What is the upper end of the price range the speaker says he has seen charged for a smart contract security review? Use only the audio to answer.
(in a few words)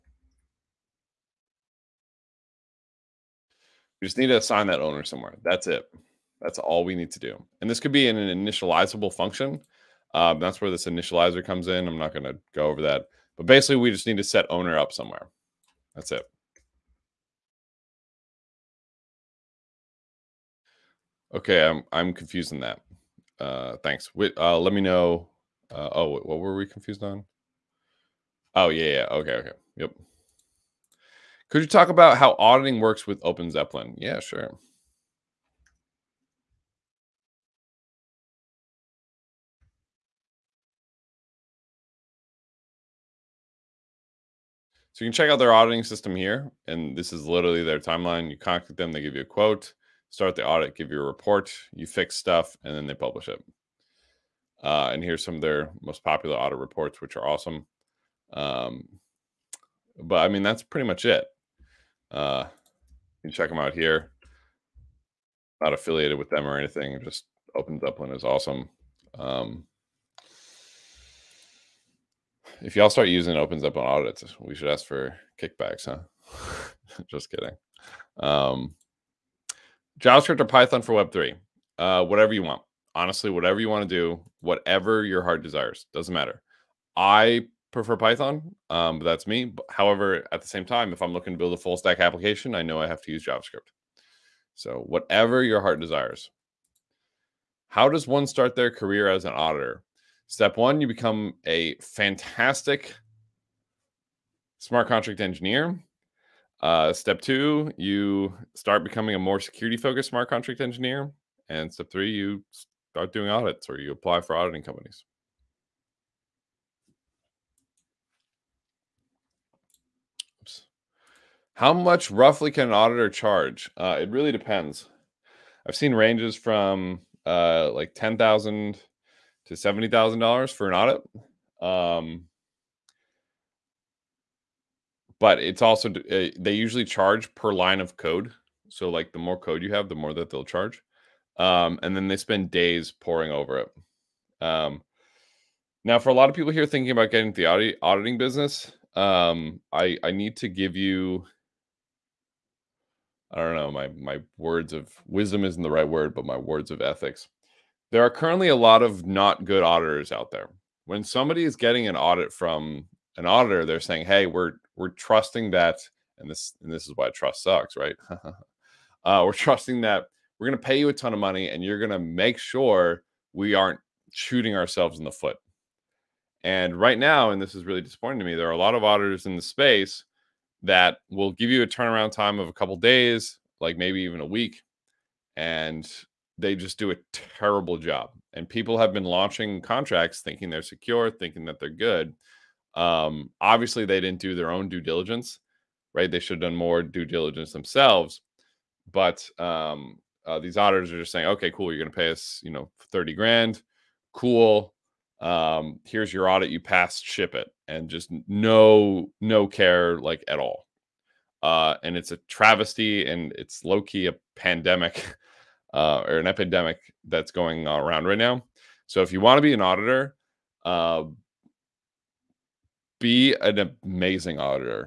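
$70,000.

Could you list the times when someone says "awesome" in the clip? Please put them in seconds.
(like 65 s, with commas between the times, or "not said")
57 s, 68 s.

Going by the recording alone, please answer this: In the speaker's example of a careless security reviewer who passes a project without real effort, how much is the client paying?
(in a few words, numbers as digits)
30 grand.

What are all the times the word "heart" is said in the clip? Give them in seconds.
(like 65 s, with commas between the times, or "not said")
85 s, 95 s.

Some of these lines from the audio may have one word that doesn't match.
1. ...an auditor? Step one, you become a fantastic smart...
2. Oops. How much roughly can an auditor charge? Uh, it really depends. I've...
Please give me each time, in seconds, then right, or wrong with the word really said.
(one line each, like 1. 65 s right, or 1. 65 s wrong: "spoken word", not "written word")
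1. 99 s right
2. 120 s right.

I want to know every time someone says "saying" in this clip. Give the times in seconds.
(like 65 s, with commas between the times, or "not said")
163 s, 201 s.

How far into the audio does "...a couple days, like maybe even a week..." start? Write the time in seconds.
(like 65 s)
182 s.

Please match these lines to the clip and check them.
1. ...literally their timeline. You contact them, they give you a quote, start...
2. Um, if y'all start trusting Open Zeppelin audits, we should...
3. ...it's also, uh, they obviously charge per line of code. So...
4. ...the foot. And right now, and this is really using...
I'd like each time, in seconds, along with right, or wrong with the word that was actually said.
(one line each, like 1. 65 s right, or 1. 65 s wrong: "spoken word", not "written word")
1. 47 s right
2. 69 s wrong: "using", not "trusting"
3. 135 s wrong: "usually", not "obviously"
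4. 175 s wrong: "disappointing", not "using".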